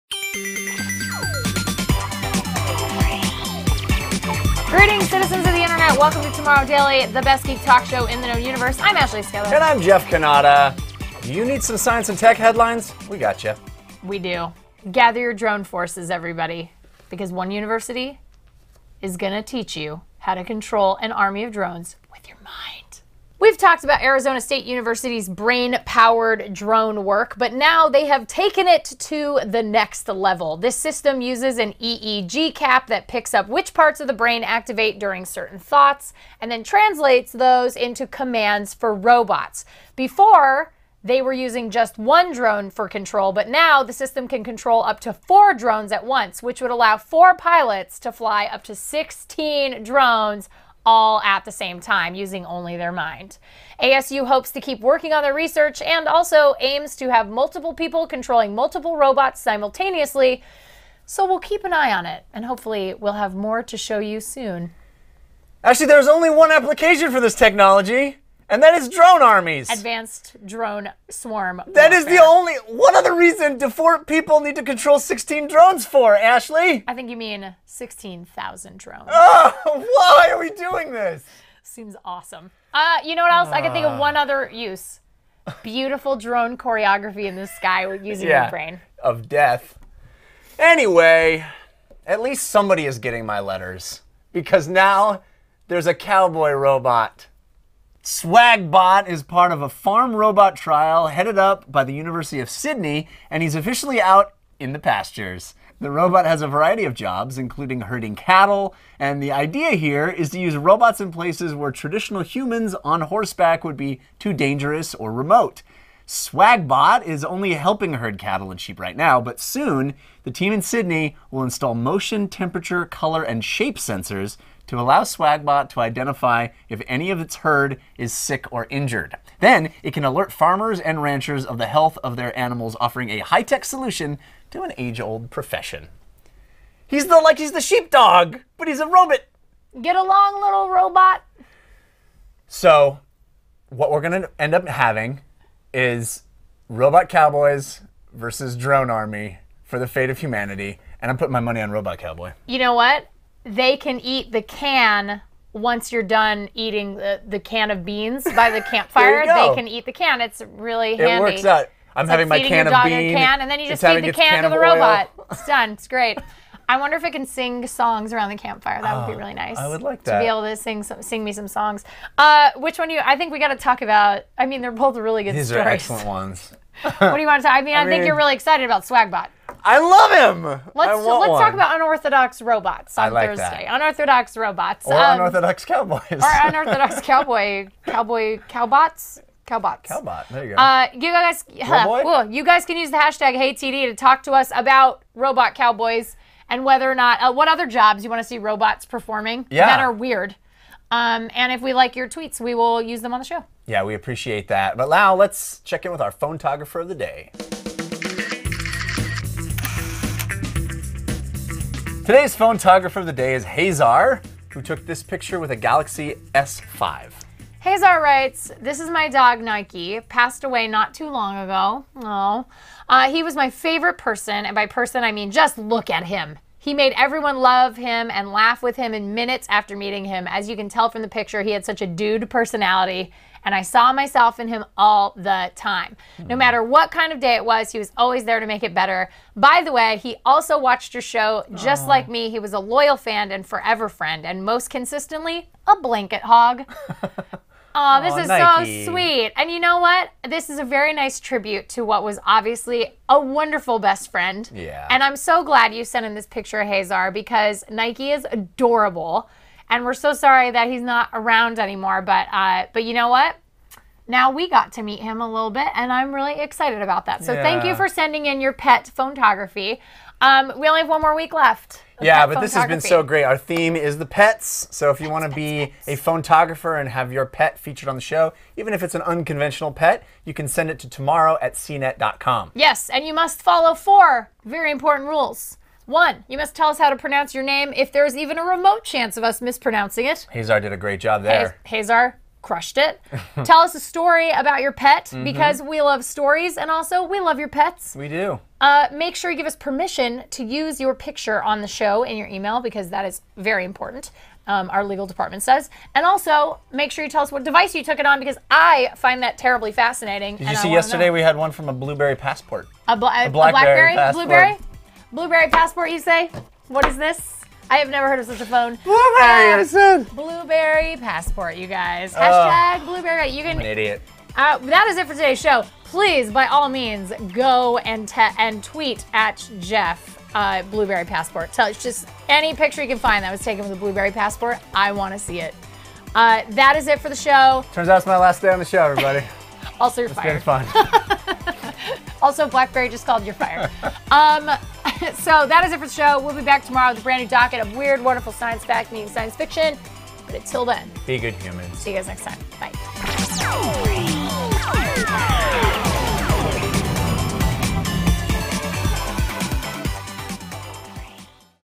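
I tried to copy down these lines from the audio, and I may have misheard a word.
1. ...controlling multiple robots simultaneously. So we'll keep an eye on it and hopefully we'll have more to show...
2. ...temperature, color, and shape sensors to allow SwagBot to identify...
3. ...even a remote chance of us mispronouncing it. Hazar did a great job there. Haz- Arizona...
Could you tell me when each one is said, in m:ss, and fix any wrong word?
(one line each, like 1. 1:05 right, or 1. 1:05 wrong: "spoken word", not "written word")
1. 0:58 right
2. 2:02 right
3. 4:48 wrong: "Hazar", not "Arizona".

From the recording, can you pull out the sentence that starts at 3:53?
And I saw myself in him all the time.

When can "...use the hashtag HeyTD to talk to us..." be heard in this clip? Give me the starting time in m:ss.
3:12.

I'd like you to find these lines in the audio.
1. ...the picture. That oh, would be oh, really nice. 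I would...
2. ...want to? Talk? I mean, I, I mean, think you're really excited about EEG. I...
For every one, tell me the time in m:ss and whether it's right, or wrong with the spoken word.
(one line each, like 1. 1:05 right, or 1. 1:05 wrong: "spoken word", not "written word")
1. 2:48 wrong: "campfire", not "picture"
2. 2:57 wrong: "Swagbot", not "EEG".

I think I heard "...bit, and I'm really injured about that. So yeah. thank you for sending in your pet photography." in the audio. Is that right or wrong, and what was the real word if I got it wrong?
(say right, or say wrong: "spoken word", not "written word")
wrong: "excited", not "injured".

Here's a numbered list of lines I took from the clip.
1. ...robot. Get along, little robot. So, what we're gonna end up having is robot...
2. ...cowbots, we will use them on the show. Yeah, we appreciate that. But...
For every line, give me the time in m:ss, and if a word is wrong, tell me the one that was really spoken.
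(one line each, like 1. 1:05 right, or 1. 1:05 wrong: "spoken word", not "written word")
1. 2:18 right
2. 3:22 wrong: "tweets", not "cowbots".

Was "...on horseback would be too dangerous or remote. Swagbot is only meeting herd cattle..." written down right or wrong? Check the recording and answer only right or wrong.
wrong.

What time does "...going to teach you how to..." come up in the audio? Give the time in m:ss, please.
0:19.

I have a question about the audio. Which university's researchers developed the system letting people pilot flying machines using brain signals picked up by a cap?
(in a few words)
Arizona State University.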